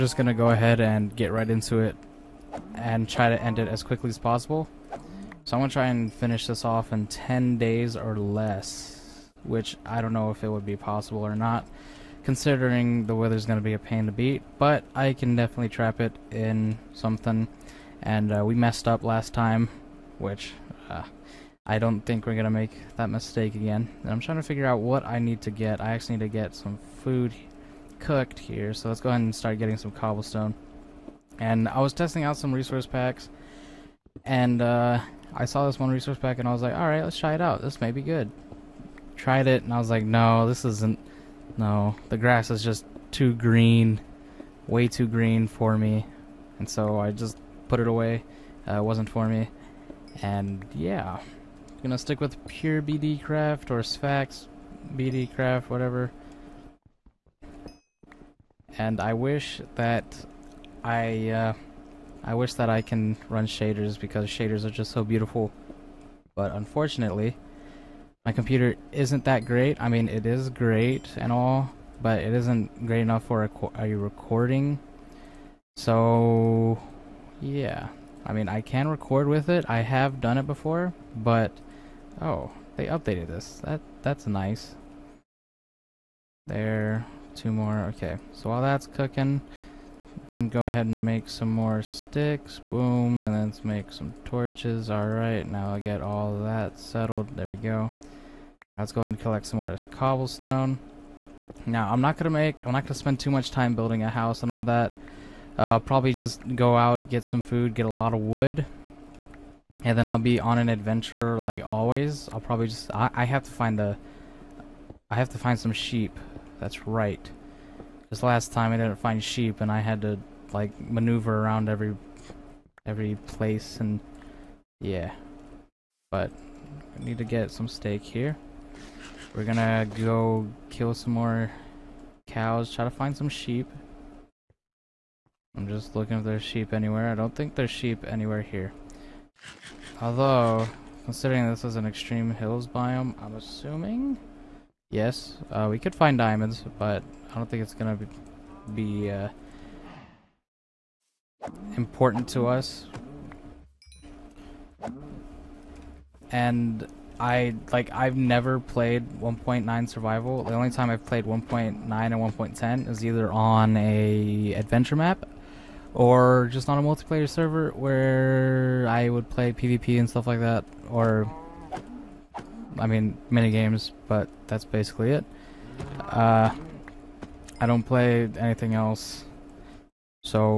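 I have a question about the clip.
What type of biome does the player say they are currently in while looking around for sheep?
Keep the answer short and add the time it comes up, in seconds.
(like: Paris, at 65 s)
Extreme hills, at 141 s.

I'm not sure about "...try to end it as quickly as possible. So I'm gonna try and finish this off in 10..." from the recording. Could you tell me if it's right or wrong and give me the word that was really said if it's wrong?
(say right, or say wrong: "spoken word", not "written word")
right.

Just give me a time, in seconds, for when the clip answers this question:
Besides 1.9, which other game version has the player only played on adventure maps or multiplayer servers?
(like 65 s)
162 s.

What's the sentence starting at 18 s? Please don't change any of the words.
And uh, we messed up last time, which uh, I don't think we're going to make that mistake again.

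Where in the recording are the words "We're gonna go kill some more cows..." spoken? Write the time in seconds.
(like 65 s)
129 s.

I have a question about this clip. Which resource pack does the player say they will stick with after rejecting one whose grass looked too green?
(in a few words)
Sphax BD craft.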